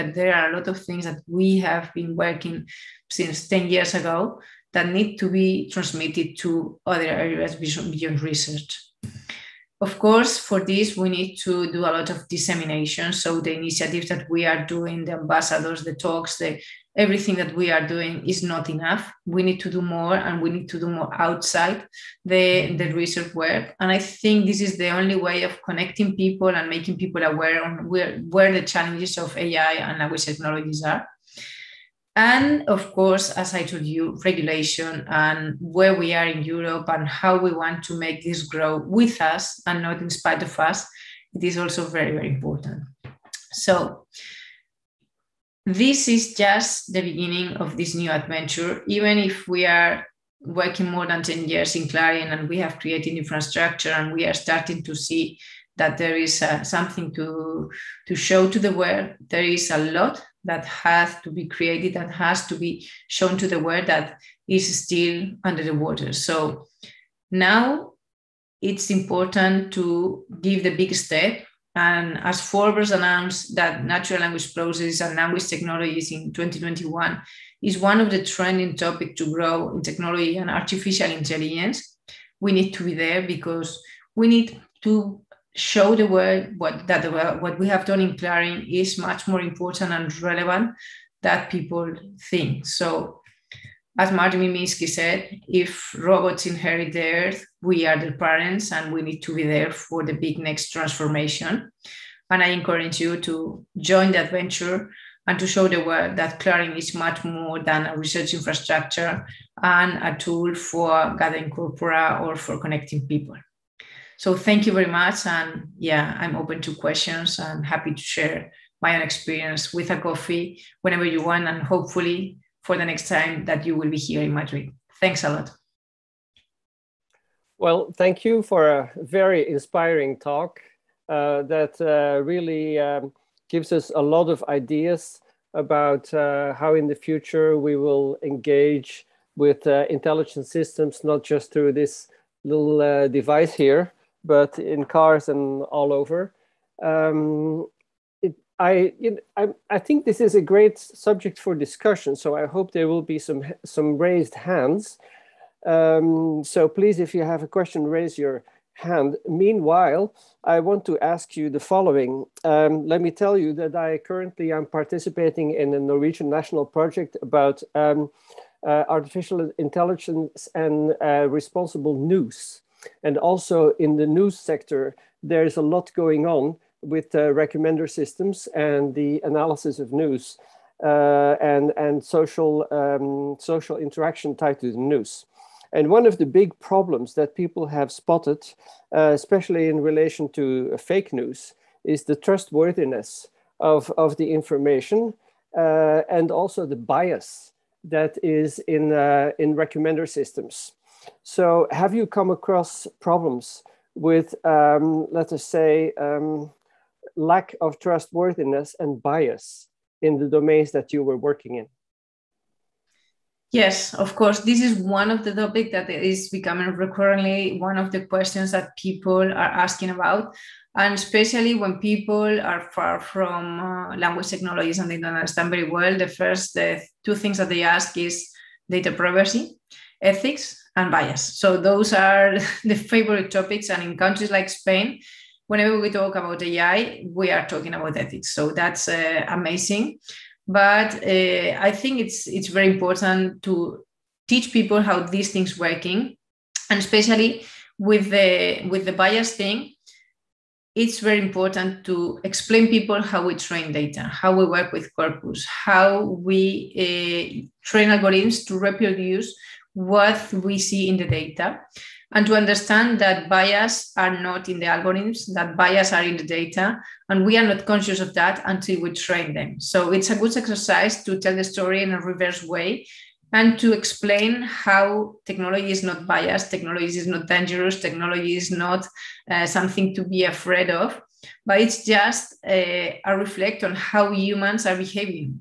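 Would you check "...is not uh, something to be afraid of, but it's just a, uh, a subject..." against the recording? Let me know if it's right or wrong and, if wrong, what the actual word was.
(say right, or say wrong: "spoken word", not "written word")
wrong: "reflect", not "subject".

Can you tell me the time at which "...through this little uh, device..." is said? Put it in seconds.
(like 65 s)
141 s.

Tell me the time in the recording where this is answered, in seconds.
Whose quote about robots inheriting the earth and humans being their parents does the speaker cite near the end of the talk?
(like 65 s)
94 s.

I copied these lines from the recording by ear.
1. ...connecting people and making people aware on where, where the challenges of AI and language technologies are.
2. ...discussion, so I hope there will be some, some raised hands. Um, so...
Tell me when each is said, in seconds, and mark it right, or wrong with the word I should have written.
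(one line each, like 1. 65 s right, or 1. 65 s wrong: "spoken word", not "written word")
1. 25 s right
2. 151 s right.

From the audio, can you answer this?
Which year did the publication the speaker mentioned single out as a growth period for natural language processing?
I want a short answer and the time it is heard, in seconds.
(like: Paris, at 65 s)
2021, at 76 s.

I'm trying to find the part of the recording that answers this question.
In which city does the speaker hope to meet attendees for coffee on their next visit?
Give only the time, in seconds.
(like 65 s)
124 s.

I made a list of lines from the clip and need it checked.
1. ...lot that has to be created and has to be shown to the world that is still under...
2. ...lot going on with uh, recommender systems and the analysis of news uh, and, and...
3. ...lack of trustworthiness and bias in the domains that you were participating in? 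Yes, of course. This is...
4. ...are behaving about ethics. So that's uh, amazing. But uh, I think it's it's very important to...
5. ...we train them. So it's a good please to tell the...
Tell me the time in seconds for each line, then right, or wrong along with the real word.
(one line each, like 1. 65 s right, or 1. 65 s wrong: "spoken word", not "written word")
1. 59 s right
2. 175 s right
3. 207 s wrong: "working", not "participating"
4. 237 s wrong: "talking", not "behaving"
5. 268 s wrong: "exercise", not "please".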